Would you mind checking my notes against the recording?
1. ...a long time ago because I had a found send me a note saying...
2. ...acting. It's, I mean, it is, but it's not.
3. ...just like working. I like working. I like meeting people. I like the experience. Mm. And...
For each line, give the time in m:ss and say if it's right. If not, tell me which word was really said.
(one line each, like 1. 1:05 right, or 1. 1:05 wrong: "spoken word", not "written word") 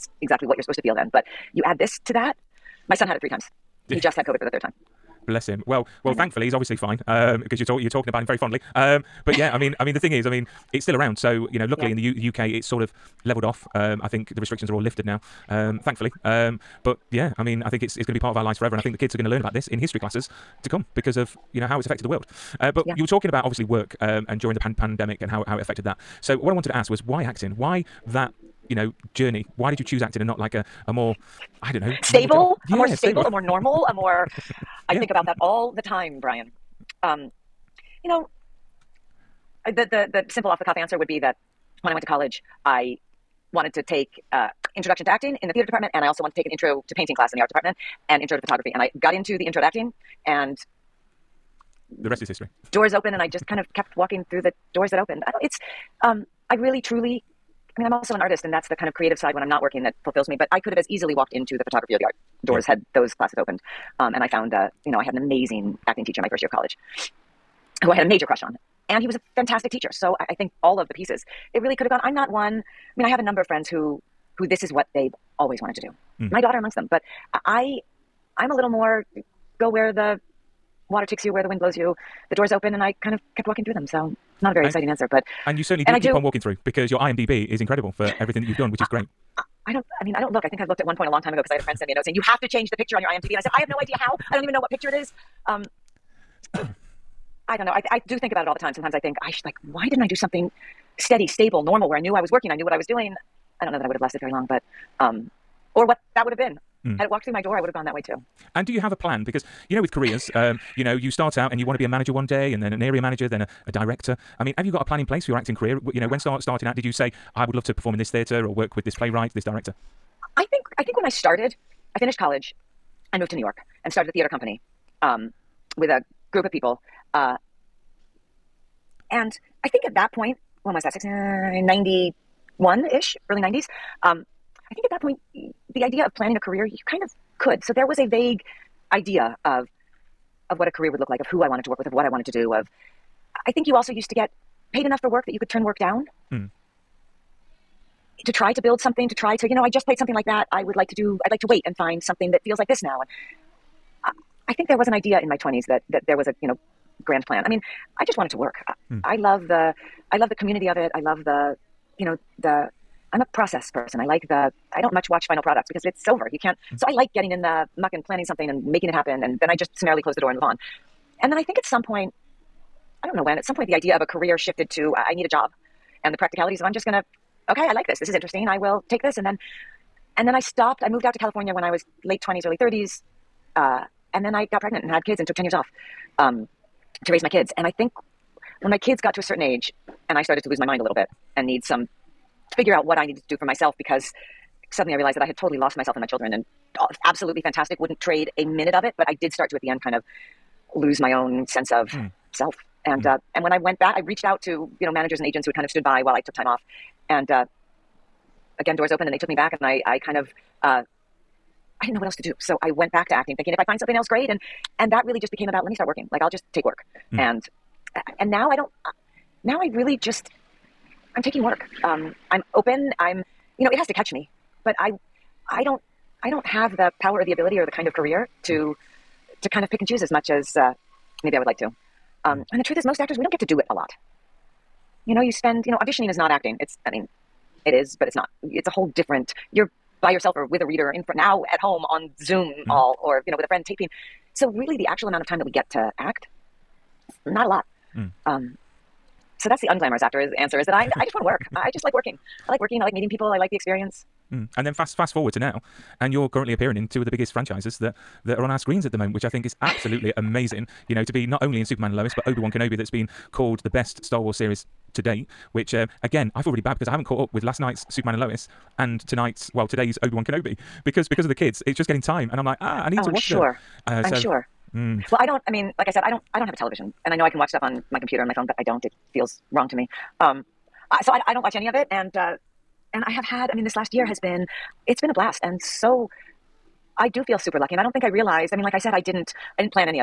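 1. 1:31 wrong: "friend", not "found"
2. 3:56 right
3. 4:11 right.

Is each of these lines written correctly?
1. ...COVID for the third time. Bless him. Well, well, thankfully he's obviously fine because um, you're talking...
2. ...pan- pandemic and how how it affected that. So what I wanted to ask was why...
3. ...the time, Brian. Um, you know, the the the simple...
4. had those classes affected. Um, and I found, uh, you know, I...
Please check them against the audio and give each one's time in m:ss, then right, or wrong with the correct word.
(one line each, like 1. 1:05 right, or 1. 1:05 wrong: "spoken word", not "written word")
1. 0:04 right
2. 0:24 right
3. 0:35 right
4. 1:02 wrong: "opened", not "affected".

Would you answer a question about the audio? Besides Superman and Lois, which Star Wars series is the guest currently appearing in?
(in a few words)
Obi-Wan Kenobi.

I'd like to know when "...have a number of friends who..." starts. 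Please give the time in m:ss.
1:13.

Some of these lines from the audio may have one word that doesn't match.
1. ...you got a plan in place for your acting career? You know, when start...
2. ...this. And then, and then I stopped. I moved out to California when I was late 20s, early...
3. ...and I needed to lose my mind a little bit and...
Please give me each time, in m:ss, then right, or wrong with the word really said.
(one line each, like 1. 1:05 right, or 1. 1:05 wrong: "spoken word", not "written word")
1. 1:54 right
2. 2:59 right
3. 3:10 wrong: "started", not "needed".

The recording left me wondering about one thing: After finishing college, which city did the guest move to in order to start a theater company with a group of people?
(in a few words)
New York.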